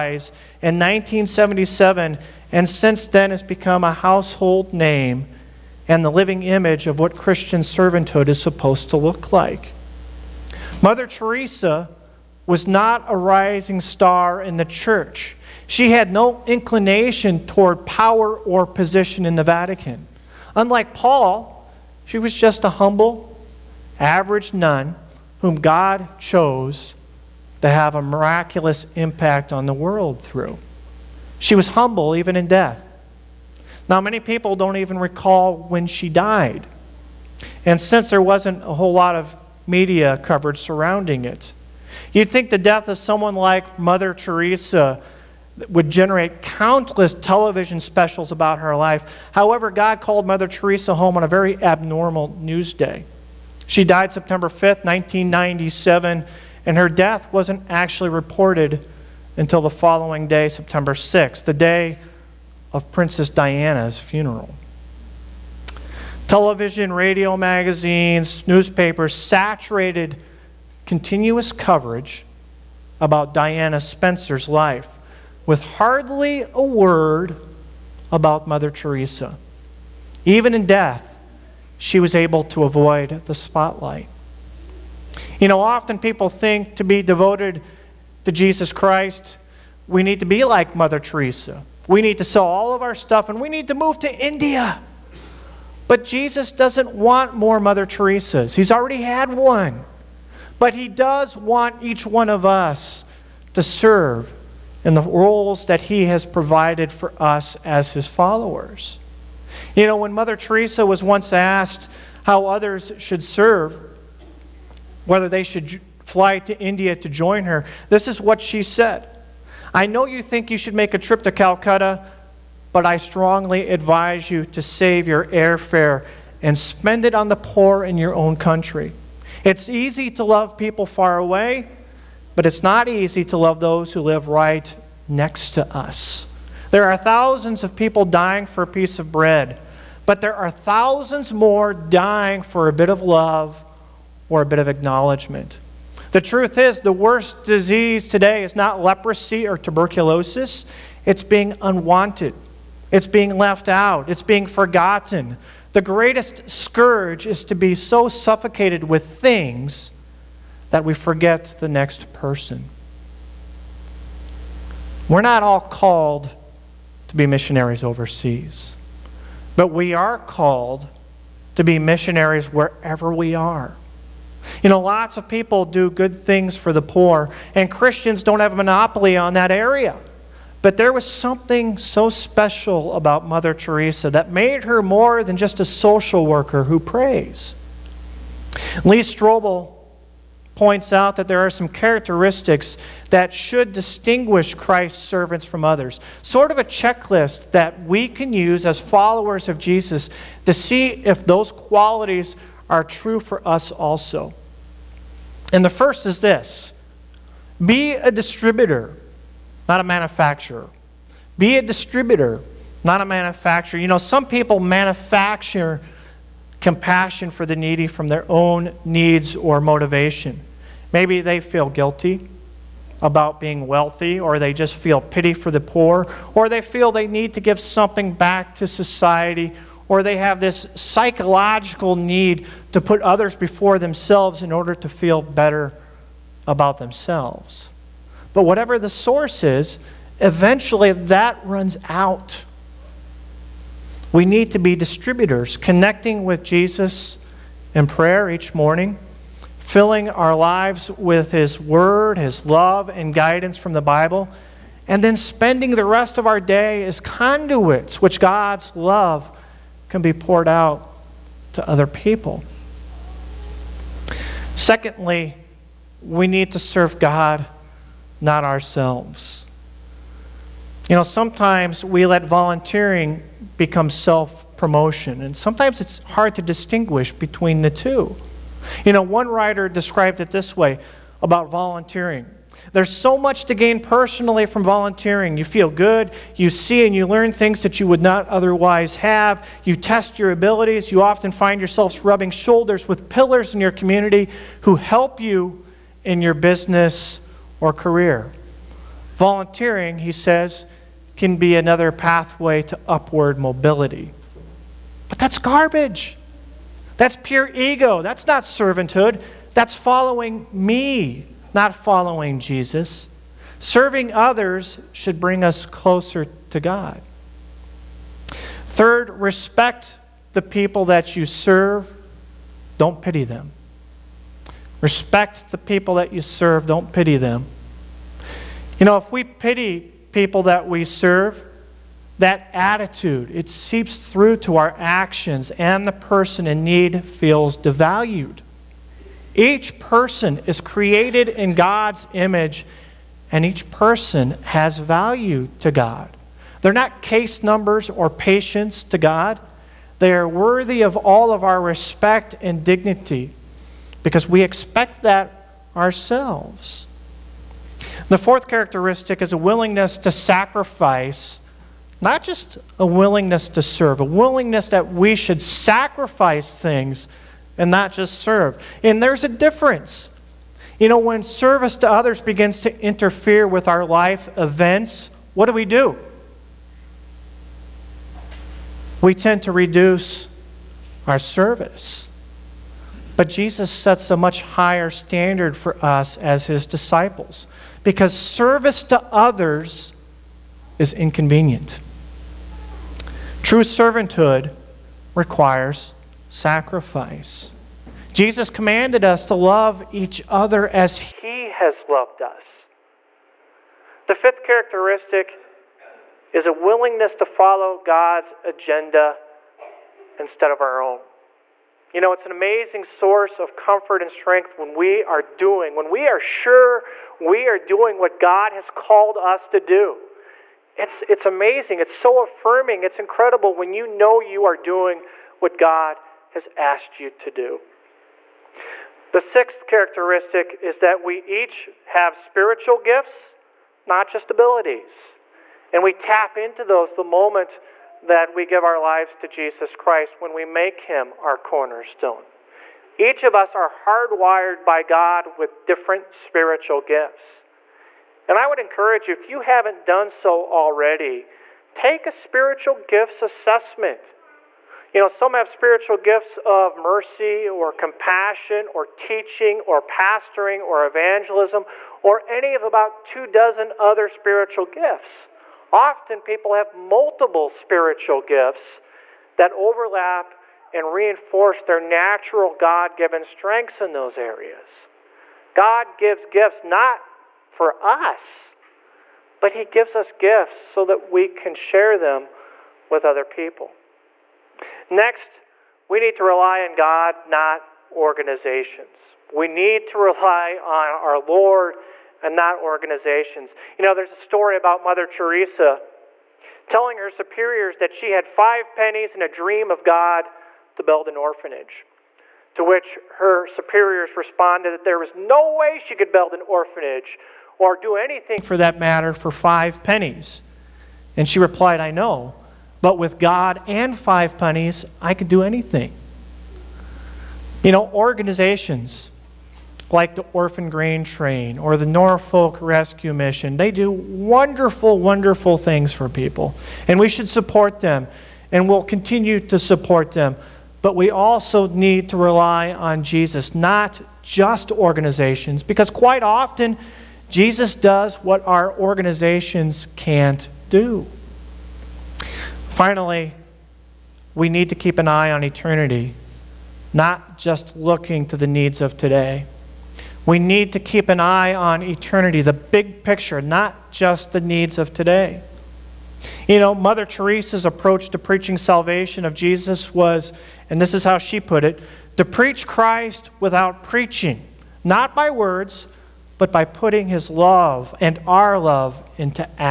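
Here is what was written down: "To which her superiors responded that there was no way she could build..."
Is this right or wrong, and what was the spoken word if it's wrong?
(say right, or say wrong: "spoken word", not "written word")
right.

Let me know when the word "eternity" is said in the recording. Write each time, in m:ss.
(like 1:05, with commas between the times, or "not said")
9:05, 9:11.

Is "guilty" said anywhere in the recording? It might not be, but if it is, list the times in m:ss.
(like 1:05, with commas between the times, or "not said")
3:41.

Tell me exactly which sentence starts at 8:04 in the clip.
Next, we need to rely on God, not organizations.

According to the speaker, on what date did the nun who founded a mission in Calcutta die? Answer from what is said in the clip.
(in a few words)
September 5th, 1997.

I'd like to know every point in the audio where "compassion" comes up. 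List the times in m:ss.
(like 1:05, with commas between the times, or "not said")
3:36, 7:37.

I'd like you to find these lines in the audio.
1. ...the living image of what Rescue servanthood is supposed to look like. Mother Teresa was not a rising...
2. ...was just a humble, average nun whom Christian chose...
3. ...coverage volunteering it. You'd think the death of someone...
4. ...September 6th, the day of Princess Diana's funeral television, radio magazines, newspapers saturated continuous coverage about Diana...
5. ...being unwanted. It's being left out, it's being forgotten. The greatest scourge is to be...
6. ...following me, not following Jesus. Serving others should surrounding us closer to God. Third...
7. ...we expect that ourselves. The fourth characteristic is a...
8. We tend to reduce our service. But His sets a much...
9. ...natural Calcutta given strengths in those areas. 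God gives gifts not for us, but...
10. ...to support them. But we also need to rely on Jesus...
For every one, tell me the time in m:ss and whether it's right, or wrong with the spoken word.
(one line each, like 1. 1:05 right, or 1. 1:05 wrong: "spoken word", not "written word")
1. 0:06 wrong: "Christian", not "Rescue"
2. 0:22 wrong: "God", not "Christian"
3. 0:40 wrong: "surrounding", not "volunteering"
4. 1:00 right
5. 2:31 right
6. 5:09 wrong: "bring", not "surrounding"
7. 5:54 right
8. 6:19 wrong: "Jesus", not "His"
9. 7:51 wrong: "God", not "Calcutta"
10. 8:49 right.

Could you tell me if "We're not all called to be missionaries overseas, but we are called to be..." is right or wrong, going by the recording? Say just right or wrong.
right.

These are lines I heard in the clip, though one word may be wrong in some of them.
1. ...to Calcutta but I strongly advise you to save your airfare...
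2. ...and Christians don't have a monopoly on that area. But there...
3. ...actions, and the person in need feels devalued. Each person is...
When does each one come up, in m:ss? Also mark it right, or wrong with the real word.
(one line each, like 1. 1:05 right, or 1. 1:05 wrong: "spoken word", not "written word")
1. 2:01 right
2. 2:57 right
3. 5:34 right.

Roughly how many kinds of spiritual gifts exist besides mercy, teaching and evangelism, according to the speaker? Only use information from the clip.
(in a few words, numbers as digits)
About two dozen.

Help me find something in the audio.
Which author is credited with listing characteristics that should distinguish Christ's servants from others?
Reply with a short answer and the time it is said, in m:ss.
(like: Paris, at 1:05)
Lee Strobel, at 3:08.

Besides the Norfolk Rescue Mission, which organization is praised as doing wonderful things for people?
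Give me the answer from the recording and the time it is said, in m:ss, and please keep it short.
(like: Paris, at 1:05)
Orphan Grain Train, at 8:40.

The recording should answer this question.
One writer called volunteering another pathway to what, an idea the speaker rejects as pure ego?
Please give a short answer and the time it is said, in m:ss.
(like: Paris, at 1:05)
Upward mobility, at 5:02.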